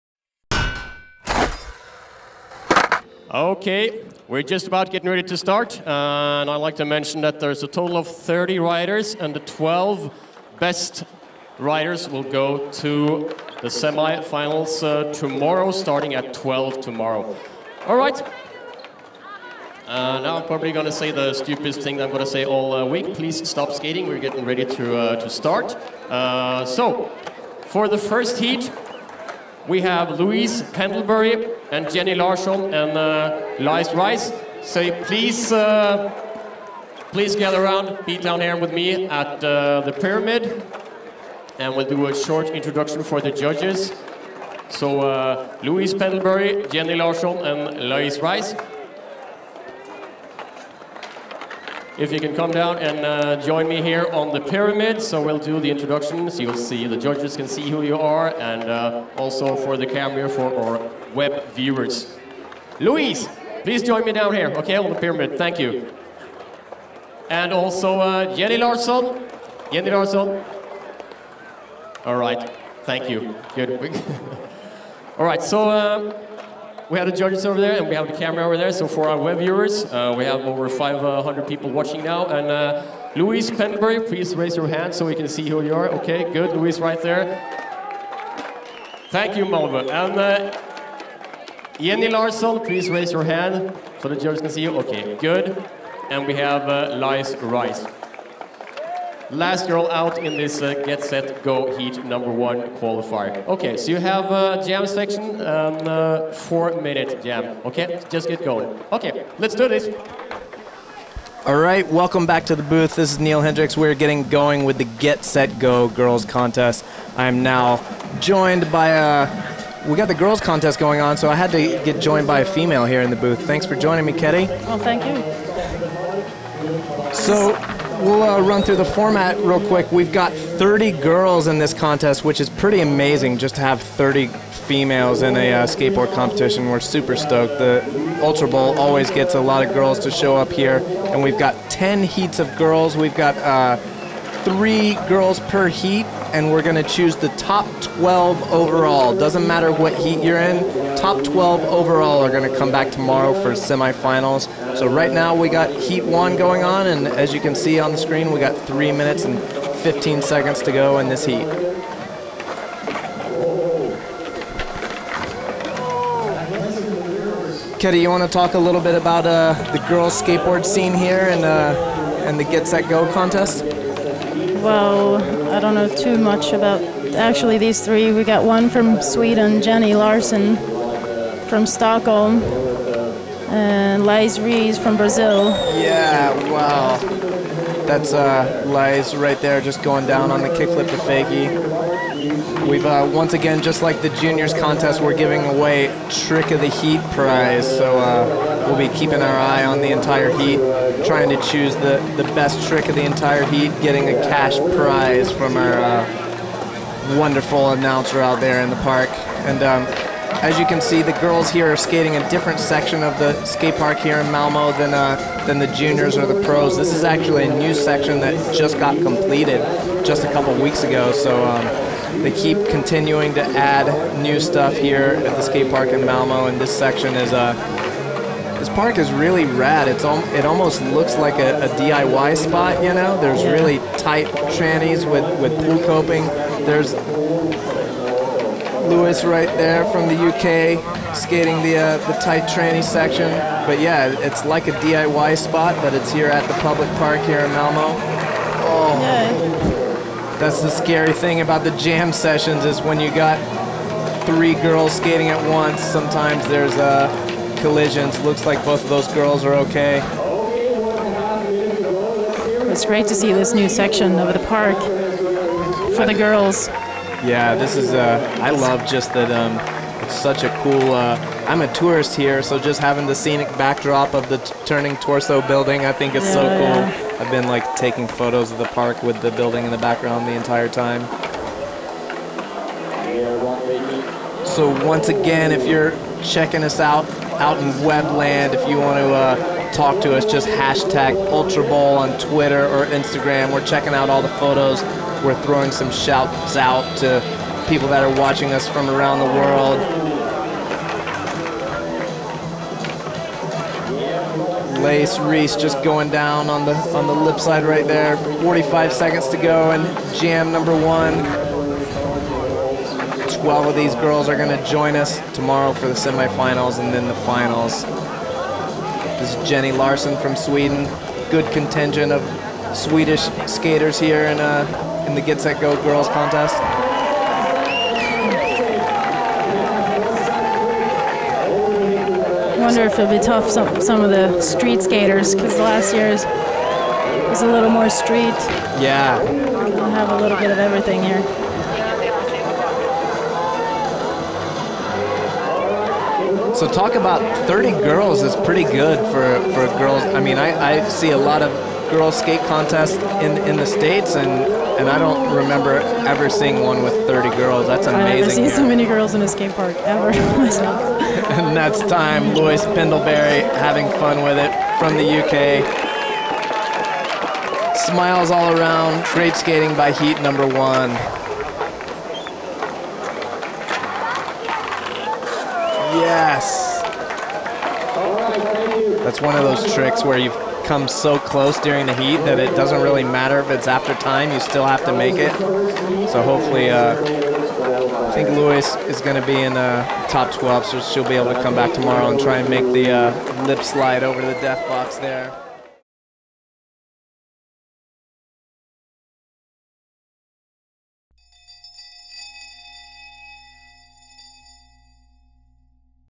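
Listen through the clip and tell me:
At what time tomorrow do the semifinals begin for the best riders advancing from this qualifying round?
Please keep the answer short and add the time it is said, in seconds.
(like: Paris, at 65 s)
12, at 15 s.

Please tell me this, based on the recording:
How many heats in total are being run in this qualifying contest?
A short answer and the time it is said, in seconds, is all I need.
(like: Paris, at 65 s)
10, at 141 s.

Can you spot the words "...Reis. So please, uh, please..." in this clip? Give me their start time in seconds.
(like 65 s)
33 s.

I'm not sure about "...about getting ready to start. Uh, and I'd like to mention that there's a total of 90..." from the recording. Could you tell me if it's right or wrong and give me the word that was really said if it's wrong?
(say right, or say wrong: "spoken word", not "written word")
wrong: "30", not "90".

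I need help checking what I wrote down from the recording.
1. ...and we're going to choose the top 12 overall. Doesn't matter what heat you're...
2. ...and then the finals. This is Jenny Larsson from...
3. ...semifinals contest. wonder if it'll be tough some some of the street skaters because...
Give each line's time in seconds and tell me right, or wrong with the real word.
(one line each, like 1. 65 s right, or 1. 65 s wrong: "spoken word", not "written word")
1. 146 s right
2. 316 s right
3. 325 s wrong: "girls", not "semifinals".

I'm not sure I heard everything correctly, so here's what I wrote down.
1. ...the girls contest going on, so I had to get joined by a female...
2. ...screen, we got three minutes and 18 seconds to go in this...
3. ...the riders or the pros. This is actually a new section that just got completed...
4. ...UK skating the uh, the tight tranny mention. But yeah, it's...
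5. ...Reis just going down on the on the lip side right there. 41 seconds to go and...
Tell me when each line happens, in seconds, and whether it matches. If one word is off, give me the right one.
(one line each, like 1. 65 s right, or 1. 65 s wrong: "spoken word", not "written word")
1. 120 s right
2. 157 s wrong: "15", not "18"
3. 215 s wrong: "juniors", not "riders"
4. 240 s wrong: "section", not "mention"
5. 305 s wrong: "45", not "41".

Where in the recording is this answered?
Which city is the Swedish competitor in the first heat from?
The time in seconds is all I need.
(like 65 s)
181 s.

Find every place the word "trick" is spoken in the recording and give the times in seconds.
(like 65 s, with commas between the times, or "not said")
196 s, 202 s, 379 s.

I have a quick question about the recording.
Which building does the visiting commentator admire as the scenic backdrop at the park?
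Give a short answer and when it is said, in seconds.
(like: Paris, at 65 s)
Turning Torso, at 274 s.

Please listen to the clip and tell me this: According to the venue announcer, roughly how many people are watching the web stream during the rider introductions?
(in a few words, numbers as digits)
over 500.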